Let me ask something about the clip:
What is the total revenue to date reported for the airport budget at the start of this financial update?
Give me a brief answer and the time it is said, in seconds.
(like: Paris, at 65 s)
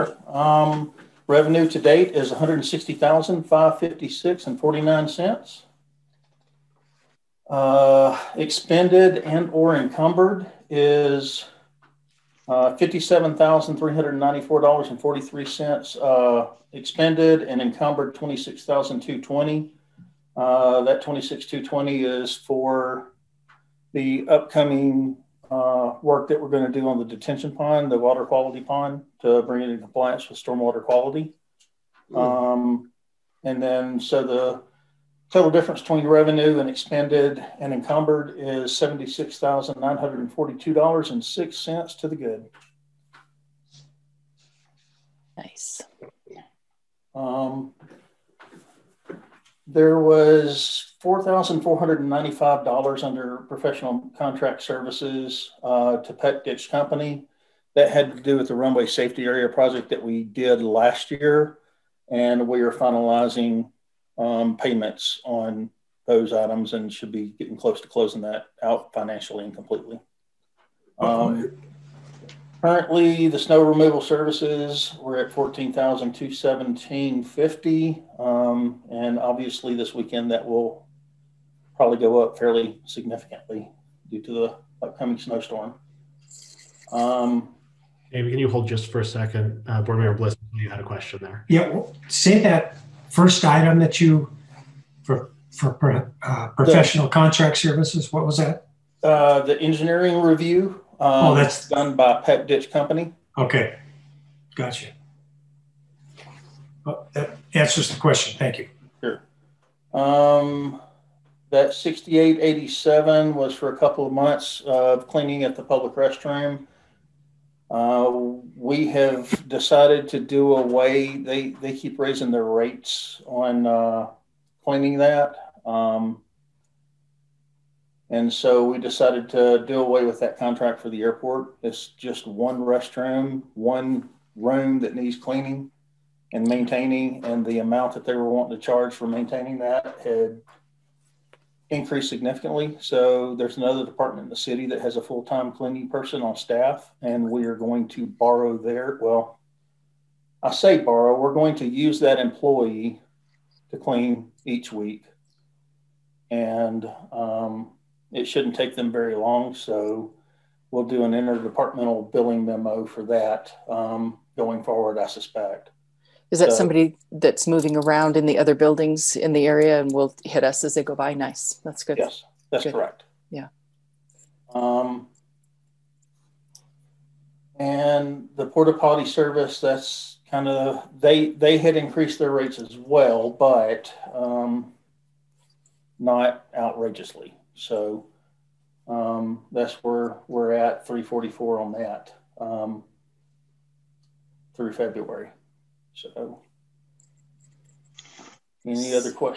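$160,556.49, at 2 s.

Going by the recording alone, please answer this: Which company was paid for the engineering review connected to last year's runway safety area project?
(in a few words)
Pet Ditch Company.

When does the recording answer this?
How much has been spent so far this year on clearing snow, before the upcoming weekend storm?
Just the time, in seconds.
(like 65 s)
75 s.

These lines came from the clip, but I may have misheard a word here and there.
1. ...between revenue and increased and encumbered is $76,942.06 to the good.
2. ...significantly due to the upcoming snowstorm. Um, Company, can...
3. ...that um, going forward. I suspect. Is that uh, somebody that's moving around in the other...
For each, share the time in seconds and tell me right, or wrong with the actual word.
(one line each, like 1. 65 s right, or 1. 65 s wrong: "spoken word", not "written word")
1. 35 s wrong: "expended", not "increased"
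2. 82 s wrong: "Amy", not "Company"
3. 163 s right.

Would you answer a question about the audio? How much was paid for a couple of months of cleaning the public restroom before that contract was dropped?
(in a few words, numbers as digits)
$6,887.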